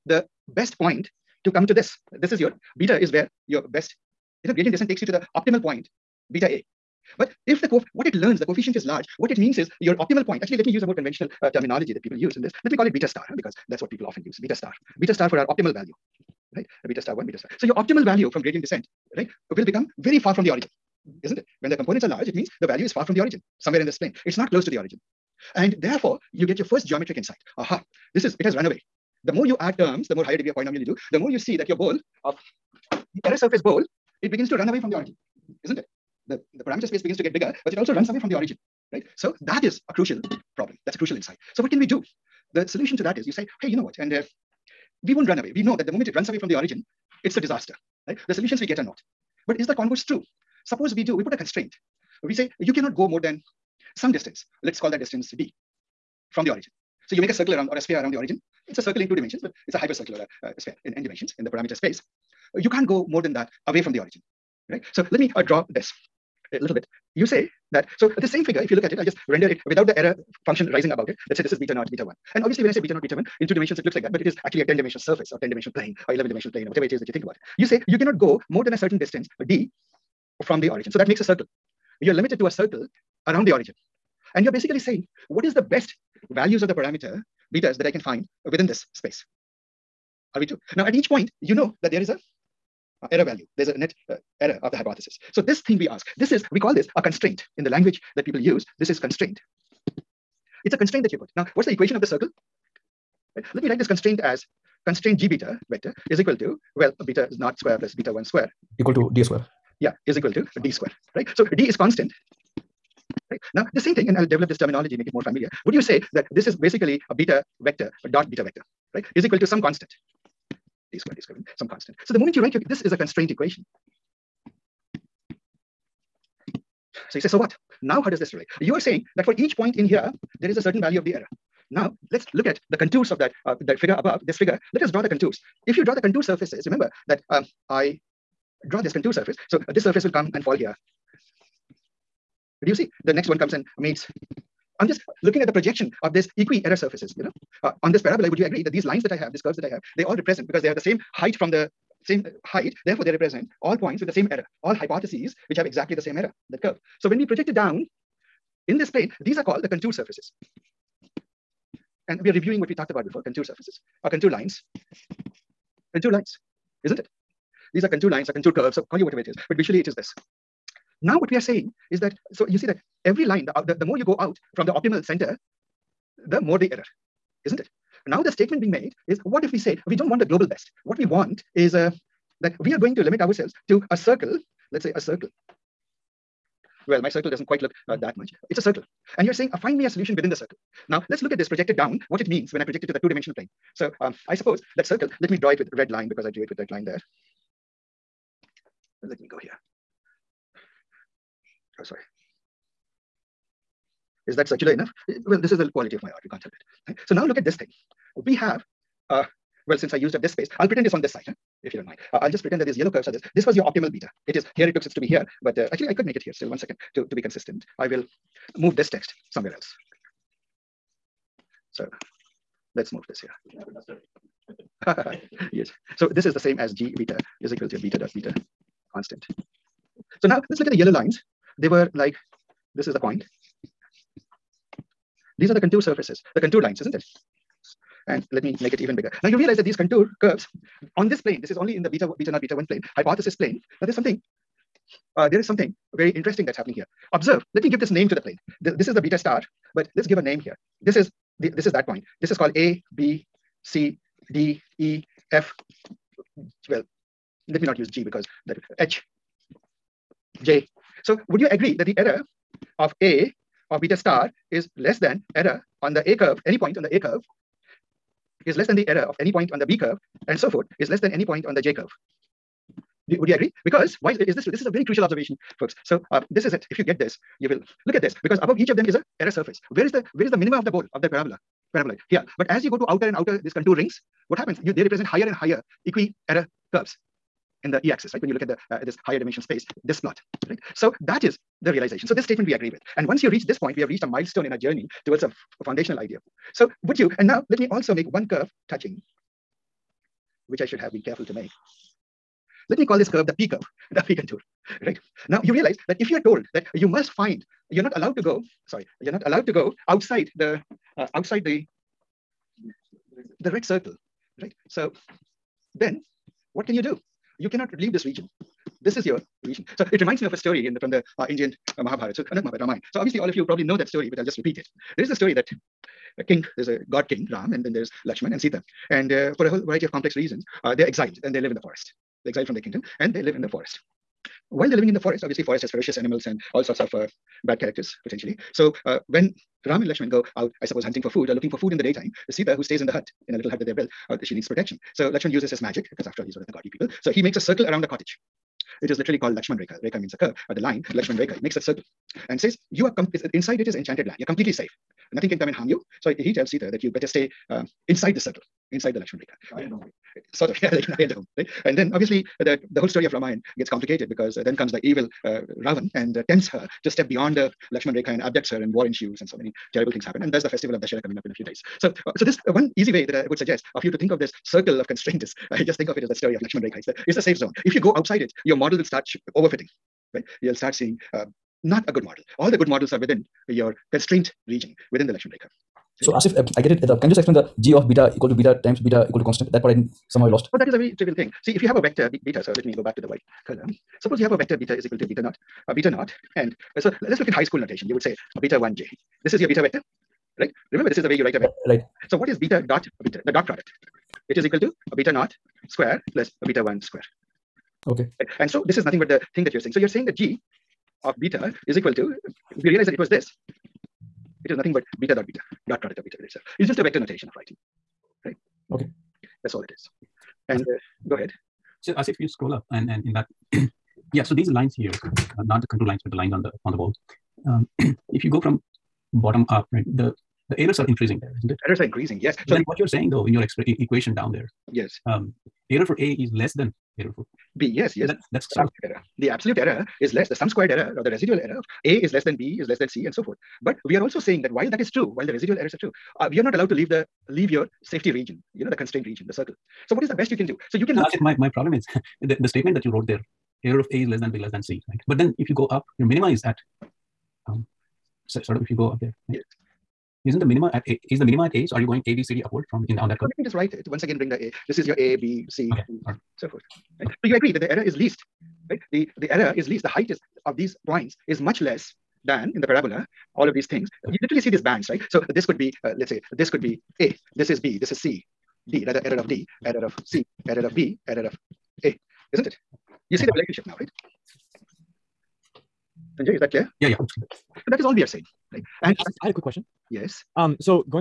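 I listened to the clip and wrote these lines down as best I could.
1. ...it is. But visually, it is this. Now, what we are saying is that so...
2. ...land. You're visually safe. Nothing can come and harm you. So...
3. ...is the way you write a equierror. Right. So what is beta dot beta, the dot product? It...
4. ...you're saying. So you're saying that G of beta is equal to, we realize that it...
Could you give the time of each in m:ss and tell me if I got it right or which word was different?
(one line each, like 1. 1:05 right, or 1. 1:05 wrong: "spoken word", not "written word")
1. 2:49 right
2. 5:54 wrong: "completely", not "visually"
3. 6:40 wrong: "vector", not "equierror"
4. 6:49 right.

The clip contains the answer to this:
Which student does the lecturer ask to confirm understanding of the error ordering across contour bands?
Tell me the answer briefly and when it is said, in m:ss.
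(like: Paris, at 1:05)
Sanjay, at 8:06.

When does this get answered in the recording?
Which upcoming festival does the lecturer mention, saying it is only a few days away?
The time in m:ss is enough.
6:10.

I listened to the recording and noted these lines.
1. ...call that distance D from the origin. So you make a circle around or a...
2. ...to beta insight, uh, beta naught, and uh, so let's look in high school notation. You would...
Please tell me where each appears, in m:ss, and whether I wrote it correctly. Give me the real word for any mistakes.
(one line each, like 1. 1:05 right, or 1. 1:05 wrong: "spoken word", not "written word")
1. 0:54 right
2. 6:34 wrong: "naught", not "insight".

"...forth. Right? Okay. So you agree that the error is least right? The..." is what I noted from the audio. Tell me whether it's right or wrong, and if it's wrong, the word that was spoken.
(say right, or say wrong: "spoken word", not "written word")
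right.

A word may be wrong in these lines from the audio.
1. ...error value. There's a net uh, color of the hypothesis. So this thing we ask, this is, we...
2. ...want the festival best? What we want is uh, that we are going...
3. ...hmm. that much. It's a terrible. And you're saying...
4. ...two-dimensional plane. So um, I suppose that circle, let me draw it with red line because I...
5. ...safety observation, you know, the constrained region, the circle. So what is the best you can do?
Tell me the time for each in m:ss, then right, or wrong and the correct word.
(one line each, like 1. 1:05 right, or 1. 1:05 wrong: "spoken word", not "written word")
1. 1:33 wrong: "error", not "color"
2. 3:00 wrong: "global", not "festival"
3. 3:07 wrong: "circle", not "terrible"
4. 3:12 right
5. 7:27 wrong: "region", not "observation".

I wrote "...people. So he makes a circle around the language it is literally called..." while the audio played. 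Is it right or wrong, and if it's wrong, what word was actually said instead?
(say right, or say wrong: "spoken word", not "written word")
wrong: "cottage", not "language".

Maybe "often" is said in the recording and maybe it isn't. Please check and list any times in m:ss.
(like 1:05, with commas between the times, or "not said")
0:14.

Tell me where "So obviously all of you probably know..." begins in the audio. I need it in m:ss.
5:22.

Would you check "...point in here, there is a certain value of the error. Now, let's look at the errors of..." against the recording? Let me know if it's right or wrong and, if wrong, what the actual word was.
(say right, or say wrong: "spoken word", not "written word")
wrong: "contours", not "errors".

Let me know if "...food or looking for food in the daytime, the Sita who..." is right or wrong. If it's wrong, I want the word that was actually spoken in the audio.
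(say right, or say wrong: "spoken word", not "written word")
right.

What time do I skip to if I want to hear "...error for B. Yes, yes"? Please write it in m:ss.
7:16.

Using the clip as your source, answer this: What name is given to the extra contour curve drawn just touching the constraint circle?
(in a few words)
P curve.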